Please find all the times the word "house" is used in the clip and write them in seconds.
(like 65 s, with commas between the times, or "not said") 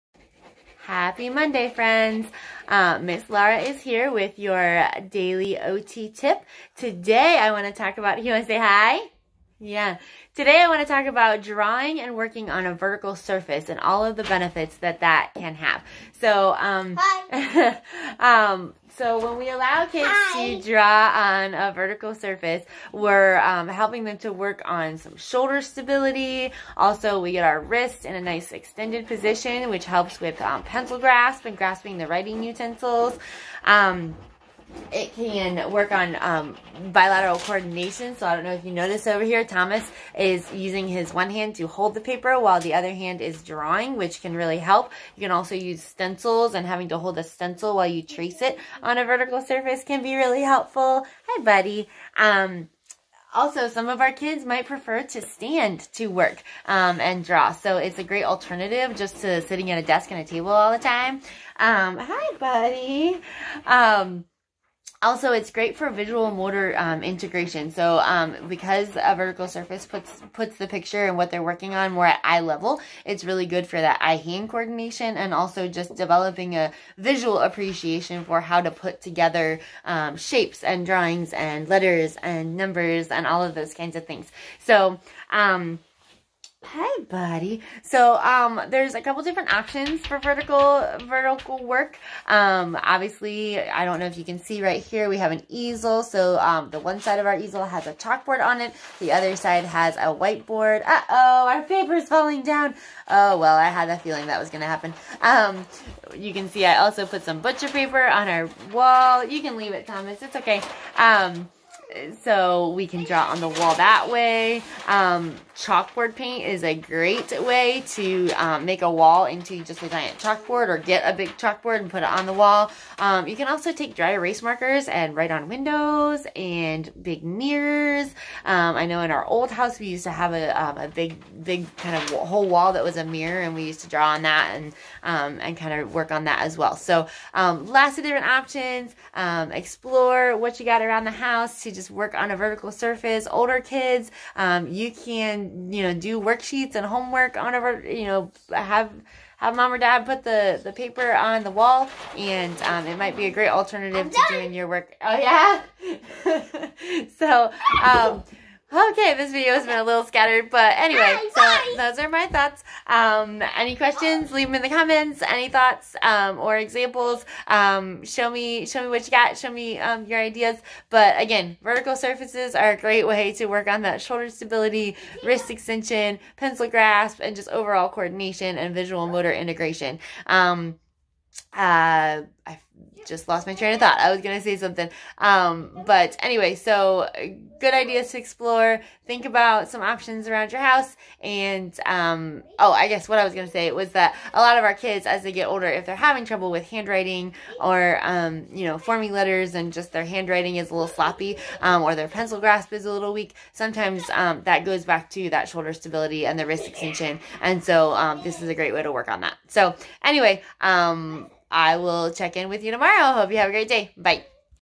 129 s, 141 s, 190 s.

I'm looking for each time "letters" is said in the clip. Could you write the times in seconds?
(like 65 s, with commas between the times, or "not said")
81 s, 199 s.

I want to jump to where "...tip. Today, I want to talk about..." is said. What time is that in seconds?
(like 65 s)
6 s.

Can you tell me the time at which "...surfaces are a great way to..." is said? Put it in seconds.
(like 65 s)
171 s.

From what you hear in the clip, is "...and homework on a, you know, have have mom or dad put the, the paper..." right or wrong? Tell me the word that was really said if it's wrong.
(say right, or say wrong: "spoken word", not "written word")
right.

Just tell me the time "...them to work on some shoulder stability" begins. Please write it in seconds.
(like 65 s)
24 s.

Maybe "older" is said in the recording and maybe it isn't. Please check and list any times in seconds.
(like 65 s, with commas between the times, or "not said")
143 s, 195 s.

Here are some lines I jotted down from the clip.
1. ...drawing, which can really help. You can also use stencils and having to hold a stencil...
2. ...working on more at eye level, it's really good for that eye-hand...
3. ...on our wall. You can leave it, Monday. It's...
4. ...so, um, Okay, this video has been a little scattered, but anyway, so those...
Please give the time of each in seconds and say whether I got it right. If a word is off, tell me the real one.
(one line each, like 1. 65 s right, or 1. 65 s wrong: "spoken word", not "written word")
1. 43 s right
2. 71 s right
3. 108 s wrong: "Thomas", not "Monday"
4. 157 s right.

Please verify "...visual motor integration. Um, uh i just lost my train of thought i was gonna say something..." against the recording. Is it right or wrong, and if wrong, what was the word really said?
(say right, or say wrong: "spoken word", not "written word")
right.